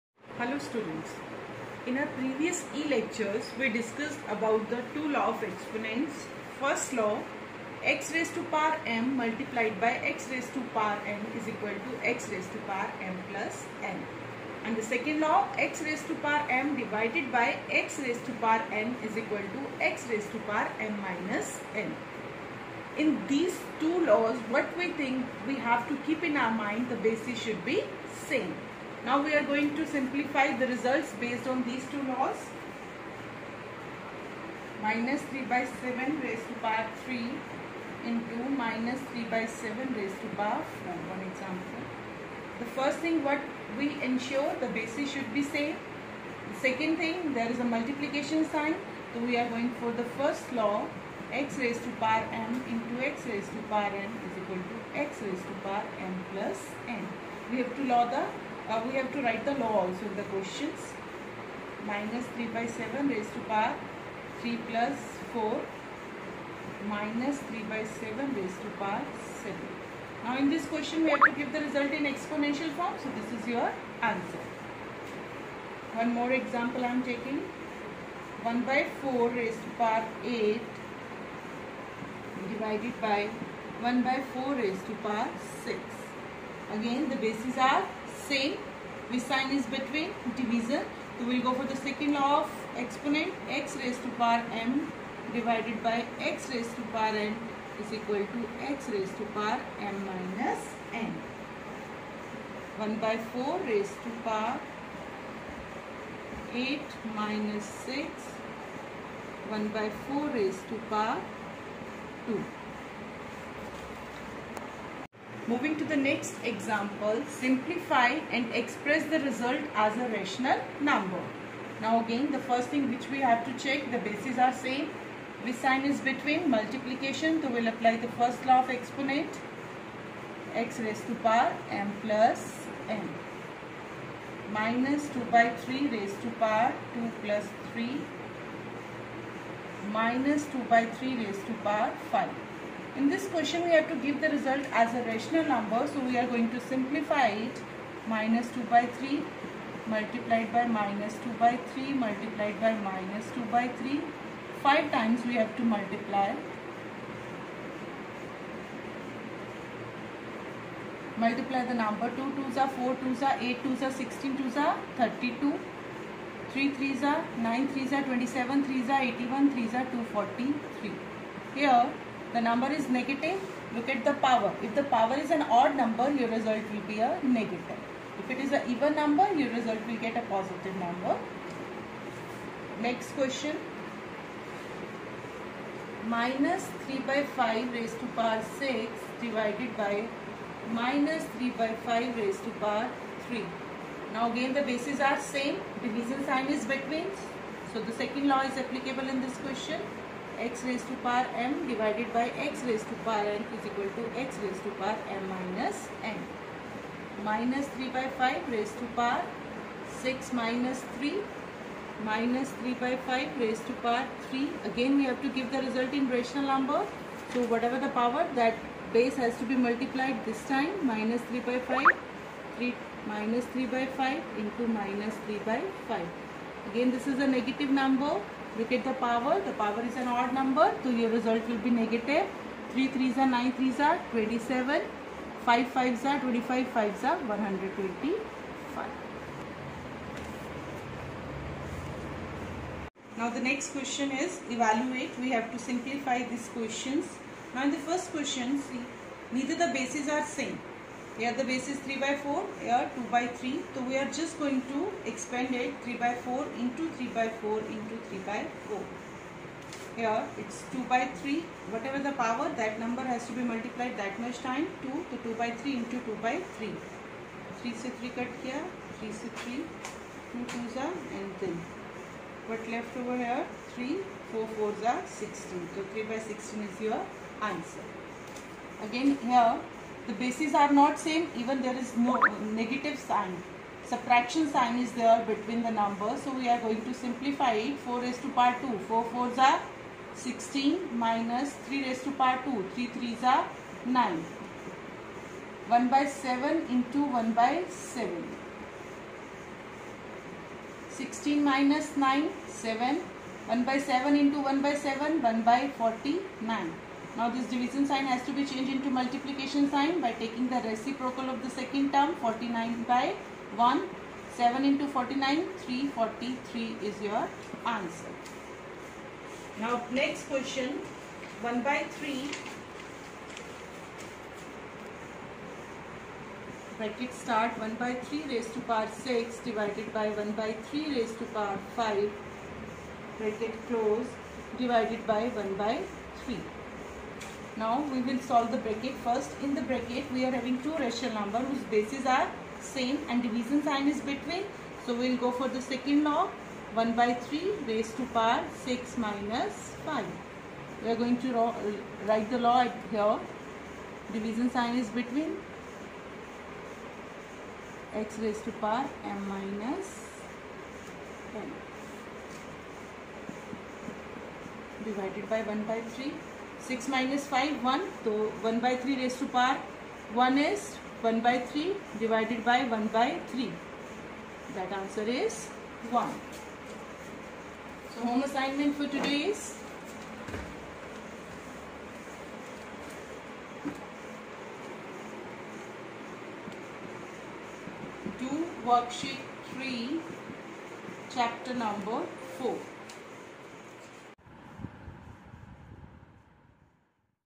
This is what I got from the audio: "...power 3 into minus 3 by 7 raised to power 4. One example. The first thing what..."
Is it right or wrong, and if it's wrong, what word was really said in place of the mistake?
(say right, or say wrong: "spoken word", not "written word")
right.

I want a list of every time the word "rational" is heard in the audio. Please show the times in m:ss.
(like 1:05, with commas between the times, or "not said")
2:00, 2:25, 3:36, 5:40.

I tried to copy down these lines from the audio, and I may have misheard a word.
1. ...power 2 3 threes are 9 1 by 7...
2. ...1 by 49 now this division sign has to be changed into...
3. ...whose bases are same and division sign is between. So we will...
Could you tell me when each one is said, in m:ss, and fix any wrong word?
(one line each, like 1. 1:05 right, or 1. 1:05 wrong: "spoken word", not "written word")
1. 4:52 right
2. 5:05 right
3. 5:41 right.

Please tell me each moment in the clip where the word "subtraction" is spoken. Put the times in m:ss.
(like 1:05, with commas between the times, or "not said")
4:43.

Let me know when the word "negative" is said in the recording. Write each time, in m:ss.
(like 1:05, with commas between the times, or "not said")
2:52, 2:57, 3:47, 3:51, 4:42.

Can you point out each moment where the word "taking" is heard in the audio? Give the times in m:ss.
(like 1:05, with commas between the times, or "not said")
1:17, 5:10.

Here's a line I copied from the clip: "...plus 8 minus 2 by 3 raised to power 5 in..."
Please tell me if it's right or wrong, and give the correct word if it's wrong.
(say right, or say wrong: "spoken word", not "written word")
wrong: "3", not "8".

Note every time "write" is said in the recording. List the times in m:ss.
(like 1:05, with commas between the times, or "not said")
0:59, 5:52.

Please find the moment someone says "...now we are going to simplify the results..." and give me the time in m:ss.
0:29.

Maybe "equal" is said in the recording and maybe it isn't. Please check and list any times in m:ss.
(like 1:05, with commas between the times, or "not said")
0:11, 0:19, 0:54, 1:37, 3:23.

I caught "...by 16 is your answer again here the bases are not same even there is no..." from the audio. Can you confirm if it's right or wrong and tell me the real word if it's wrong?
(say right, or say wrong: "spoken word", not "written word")
right.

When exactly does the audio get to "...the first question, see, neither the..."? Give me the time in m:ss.
4:07.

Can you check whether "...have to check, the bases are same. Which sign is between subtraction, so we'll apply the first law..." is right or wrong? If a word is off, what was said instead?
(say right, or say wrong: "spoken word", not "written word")
wrong: "multiplication", not "subtraction".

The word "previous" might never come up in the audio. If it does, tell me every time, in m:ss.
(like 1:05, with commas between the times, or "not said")
0:02.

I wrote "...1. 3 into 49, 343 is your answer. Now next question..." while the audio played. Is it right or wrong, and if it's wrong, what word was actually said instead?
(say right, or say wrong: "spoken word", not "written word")
wrong: "7", not "3".